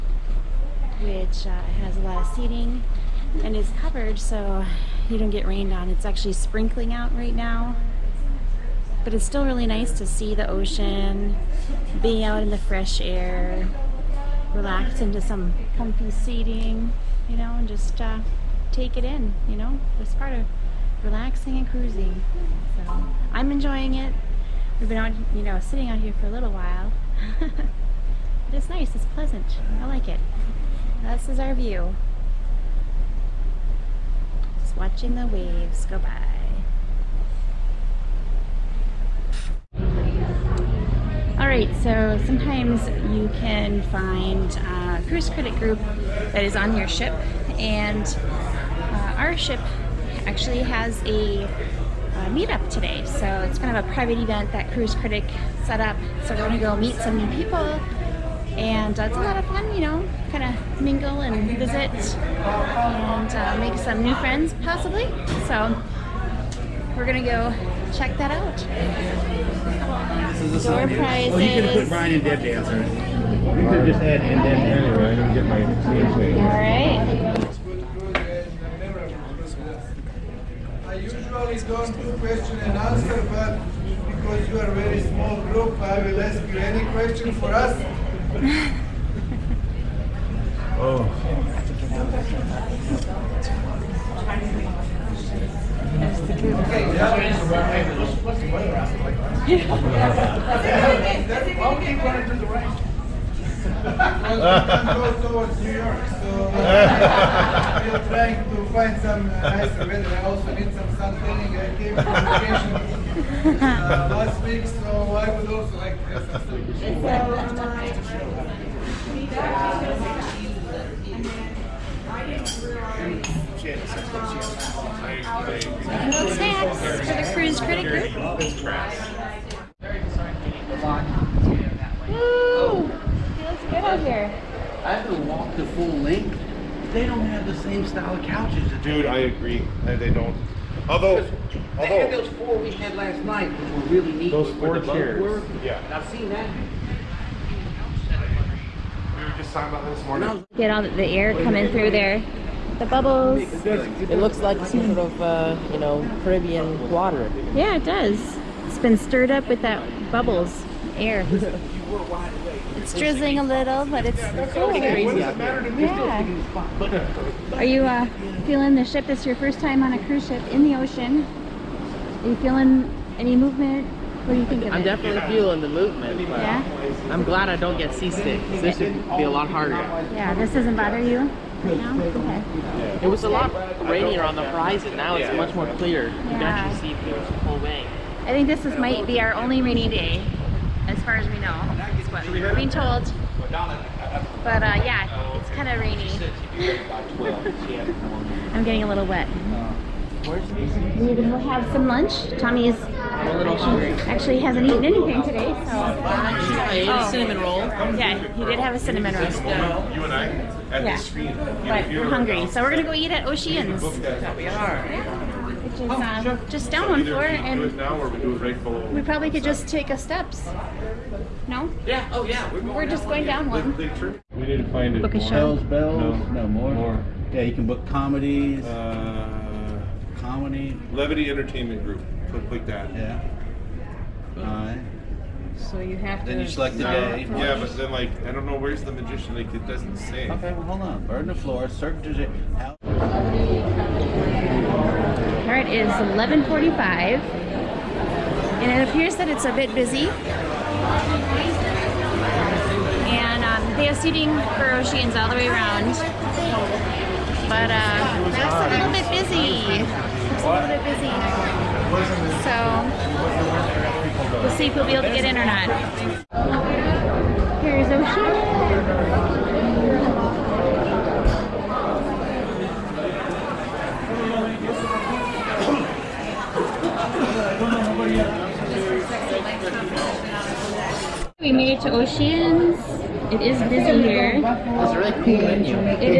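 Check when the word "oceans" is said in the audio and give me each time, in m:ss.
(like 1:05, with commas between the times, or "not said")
0:10, 2:50, 3:33, 4:14, 4:27, 4:41.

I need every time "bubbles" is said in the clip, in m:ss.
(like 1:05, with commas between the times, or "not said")
2:32, 2:40.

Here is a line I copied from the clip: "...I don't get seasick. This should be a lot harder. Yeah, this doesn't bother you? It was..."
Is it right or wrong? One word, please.
right.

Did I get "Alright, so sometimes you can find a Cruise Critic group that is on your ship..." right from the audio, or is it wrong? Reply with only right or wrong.
right.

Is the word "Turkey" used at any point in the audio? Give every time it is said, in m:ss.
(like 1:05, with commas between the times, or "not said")
not said.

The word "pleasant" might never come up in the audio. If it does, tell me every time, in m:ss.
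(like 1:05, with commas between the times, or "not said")
0:29.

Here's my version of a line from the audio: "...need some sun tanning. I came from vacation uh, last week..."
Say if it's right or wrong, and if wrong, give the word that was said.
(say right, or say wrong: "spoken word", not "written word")
right.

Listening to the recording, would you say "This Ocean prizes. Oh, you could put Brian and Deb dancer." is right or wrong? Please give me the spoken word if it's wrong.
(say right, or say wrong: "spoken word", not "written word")
wrong: "Door", not "Ocean".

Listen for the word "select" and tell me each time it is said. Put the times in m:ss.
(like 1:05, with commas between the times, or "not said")
3:56.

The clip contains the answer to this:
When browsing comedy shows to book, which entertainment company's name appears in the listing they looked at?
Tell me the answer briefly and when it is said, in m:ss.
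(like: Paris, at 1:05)
Levity Entertainment Group, at 3:50.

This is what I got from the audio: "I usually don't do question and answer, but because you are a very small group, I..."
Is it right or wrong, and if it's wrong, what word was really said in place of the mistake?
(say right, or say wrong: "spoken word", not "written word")
right.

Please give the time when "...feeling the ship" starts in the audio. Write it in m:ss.
2:48.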